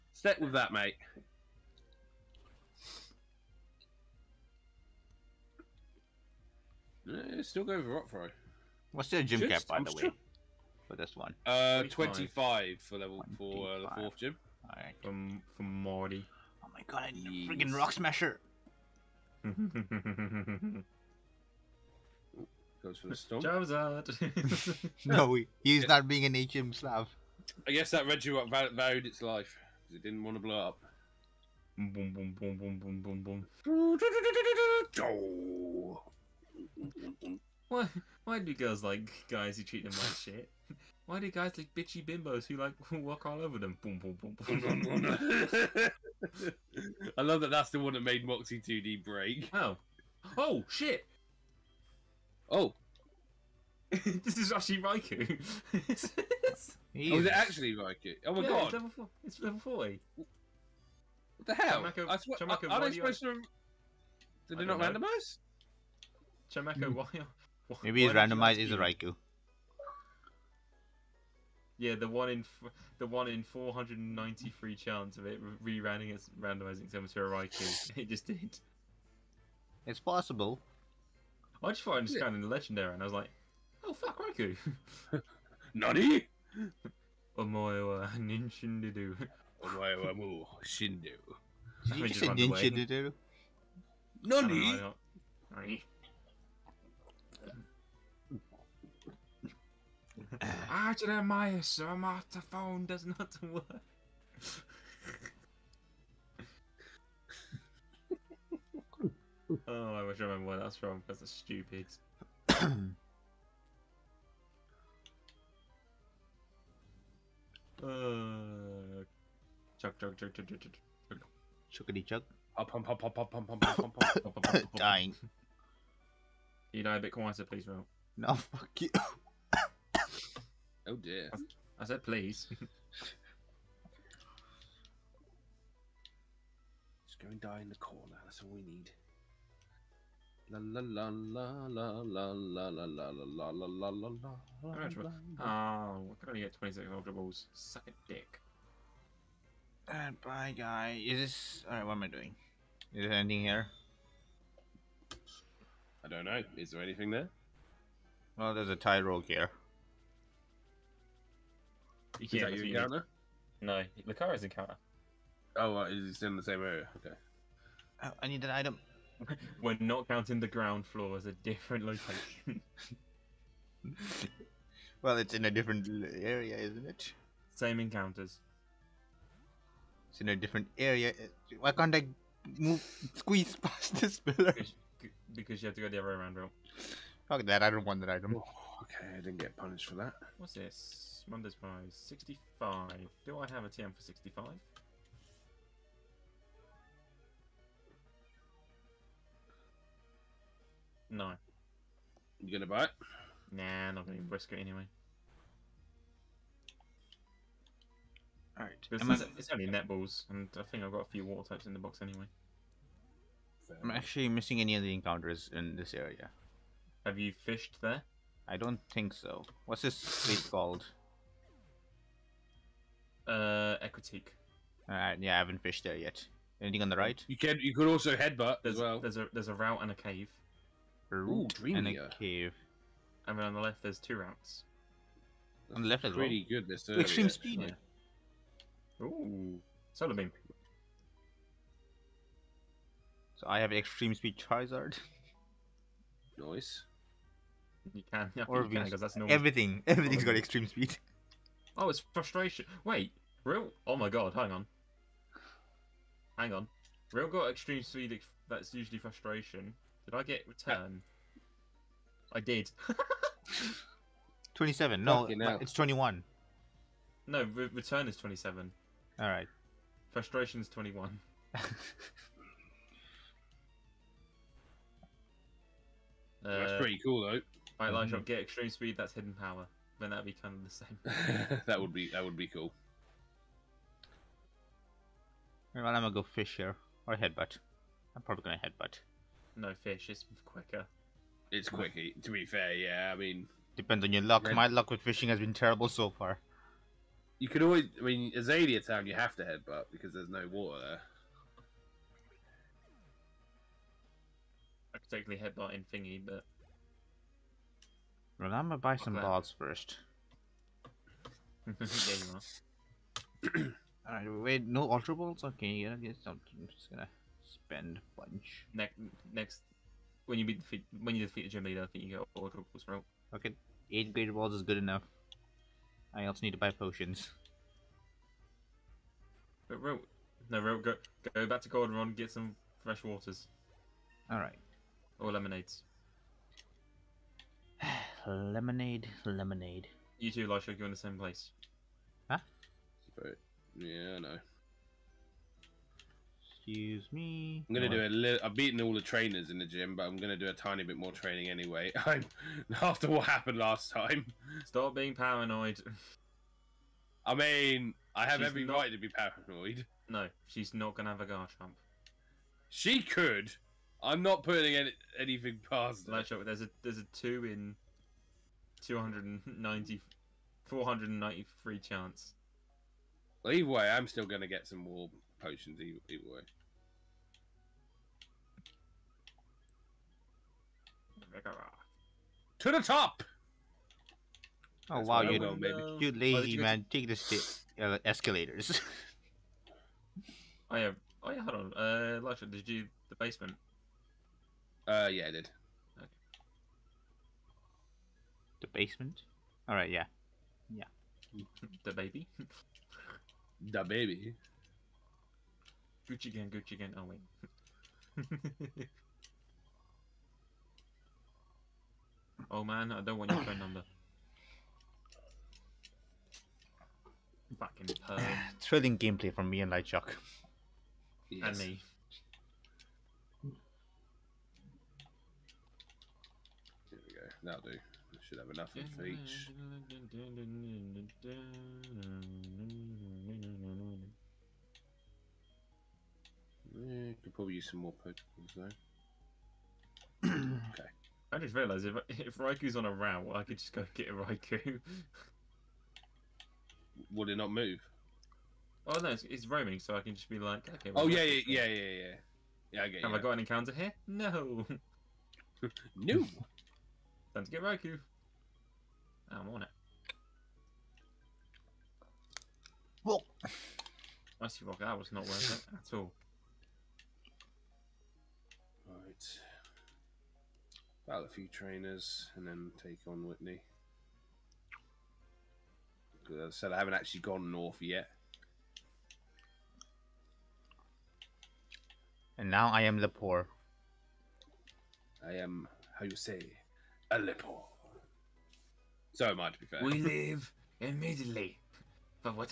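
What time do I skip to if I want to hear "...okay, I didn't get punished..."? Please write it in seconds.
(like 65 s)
188 s.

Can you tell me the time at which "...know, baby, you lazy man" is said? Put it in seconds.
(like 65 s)
385 s.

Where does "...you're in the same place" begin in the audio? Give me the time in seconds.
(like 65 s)
340 s.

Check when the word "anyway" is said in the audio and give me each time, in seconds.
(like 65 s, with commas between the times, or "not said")
204 s, 212 s, 351 s.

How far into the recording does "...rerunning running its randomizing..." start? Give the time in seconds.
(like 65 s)
75 s.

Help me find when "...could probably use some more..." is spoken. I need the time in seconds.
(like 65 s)
437 s.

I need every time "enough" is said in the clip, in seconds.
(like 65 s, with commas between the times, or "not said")
324 s, 428 s.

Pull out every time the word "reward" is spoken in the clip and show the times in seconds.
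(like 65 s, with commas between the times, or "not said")
not said.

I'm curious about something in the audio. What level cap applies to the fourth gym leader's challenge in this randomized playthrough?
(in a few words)
25.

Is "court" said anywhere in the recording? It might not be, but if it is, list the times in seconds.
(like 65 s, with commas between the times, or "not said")
not said.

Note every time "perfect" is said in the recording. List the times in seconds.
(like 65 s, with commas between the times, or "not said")
not said.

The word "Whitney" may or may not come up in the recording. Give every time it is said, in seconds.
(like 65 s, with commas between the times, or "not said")
473 s.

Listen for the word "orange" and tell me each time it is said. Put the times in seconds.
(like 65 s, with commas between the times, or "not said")
not said.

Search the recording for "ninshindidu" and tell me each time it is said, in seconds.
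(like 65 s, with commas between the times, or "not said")
88 s, 92 s.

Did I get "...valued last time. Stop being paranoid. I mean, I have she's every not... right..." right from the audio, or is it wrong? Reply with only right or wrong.
wrong.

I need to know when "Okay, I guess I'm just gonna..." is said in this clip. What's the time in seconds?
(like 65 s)
315 s.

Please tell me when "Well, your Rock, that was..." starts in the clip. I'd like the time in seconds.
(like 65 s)
463 s.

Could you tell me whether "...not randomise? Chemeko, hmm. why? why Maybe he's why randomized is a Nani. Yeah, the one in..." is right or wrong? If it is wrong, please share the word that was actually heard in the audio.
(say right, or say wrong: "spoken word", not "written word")
wrong: "Raikou", not "Nani".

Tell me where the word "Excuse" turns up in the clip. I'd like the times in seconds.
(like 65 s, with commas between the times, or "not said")
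346 s.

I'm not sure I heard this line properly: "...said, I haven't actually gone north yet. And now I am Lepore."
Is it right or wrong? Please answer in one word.
right.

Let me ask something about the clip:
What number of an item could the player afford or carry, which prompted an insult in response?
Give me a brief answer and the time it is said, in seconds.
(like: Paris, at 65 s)
26, at 146 s.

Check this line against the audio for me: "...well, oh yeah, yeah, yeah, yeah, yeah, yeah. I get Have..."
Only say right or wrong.
right.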